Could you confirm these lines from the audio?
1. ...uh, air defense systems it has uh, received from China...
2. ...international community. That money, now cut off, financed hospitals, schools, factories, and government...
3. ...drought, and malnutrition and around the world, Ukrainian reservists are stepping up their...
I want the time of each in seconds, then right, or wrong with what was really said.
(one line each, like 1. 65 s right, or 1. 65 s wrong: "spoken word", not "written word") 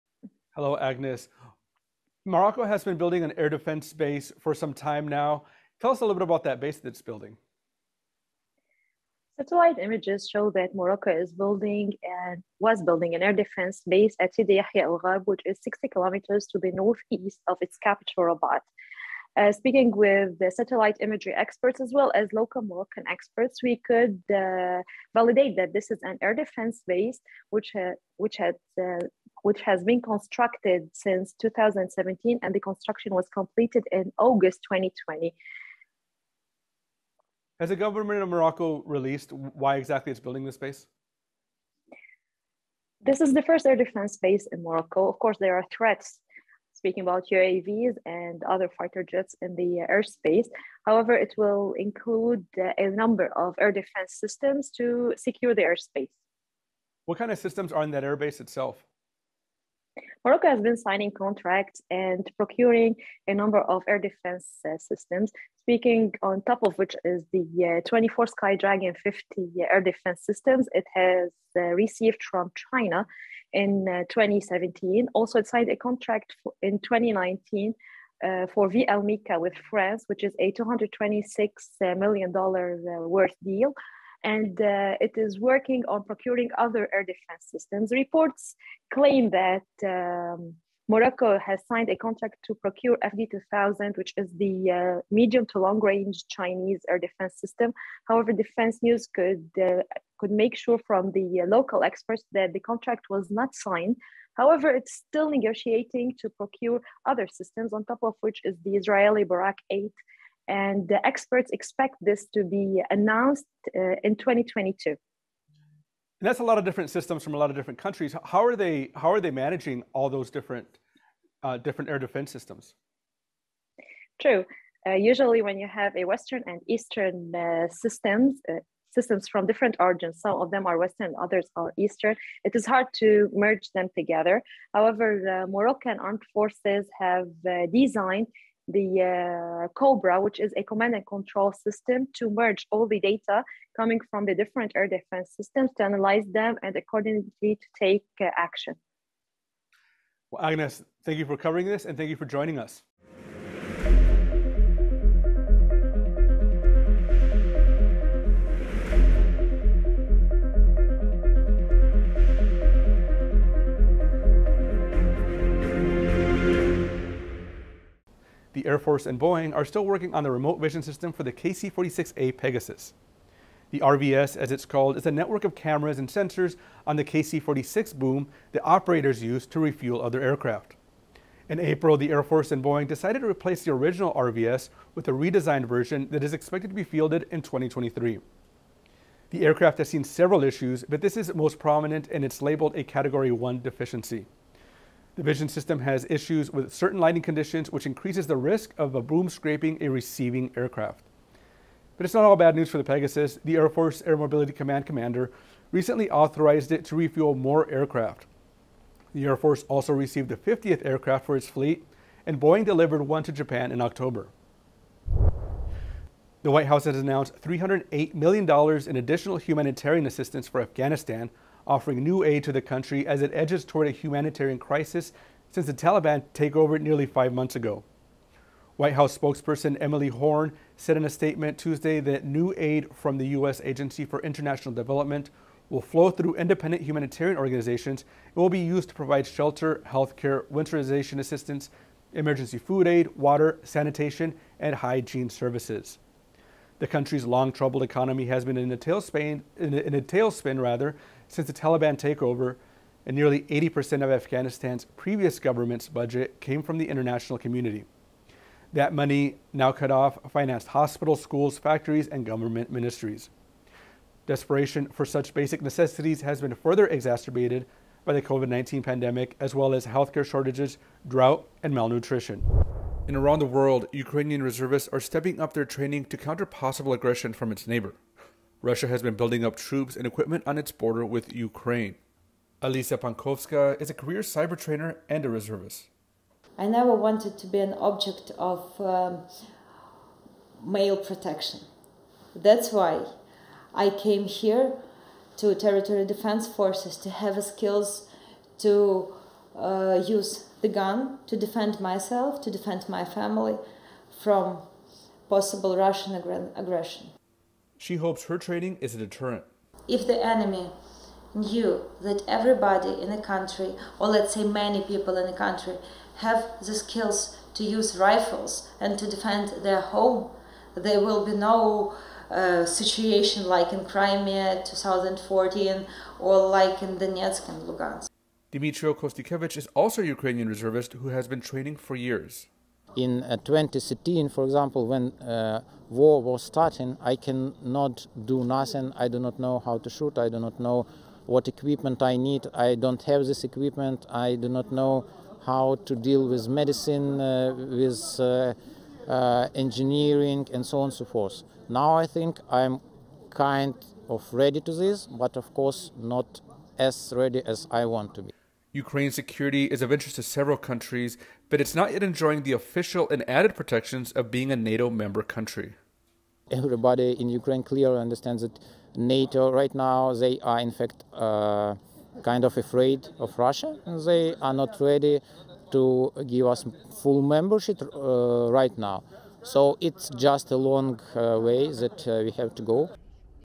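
1. 69 s right
2. 256 s right
3. 271 s right.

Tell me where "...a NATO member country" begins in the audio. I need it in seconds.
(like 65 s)
364 s.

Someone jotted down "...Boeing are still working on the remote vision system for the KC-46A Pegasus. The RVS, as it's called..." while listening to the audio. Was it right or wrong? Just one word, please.
right.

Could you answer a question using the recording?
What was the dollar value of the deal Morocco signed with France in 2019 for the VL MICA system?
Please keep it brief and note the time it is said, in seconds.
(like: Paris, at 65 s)
$226 million, at 80 s.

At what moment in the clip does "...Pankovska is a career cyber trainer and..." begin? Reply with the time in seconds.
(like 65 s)
283 s.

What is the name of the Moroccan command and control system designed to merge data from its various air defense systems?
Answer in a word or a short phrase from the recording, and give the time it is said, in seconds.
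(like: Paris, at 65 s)
COBRA, at 139 s.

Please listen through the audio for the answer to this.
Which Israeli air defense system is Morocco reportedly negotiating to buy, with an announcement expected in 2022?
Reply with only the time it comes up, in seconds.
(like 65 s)
109 s.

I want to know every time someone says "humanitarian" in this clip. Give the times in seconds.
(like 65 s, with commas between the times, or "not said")
219 s, 223 s, 236 s.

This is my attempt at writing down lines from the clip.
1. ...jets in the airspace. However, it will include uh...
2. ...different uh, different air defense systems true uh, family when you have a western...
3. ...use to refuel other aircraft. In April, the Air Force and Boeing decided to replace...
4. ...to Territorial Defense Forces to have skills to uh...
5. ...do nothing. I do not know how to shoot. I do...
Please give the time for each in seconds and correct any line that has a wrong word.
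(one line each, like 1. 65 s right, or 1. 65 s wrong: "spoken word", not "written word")
1. 49 s right
2. 120 s wrong: "usually", not "family"
3. 179 s right
4. 295 s right
5. 338 s right.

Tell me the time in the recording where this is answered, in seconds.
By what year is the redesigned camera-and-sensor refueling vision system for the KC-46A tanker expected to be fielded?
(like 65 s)
187 s.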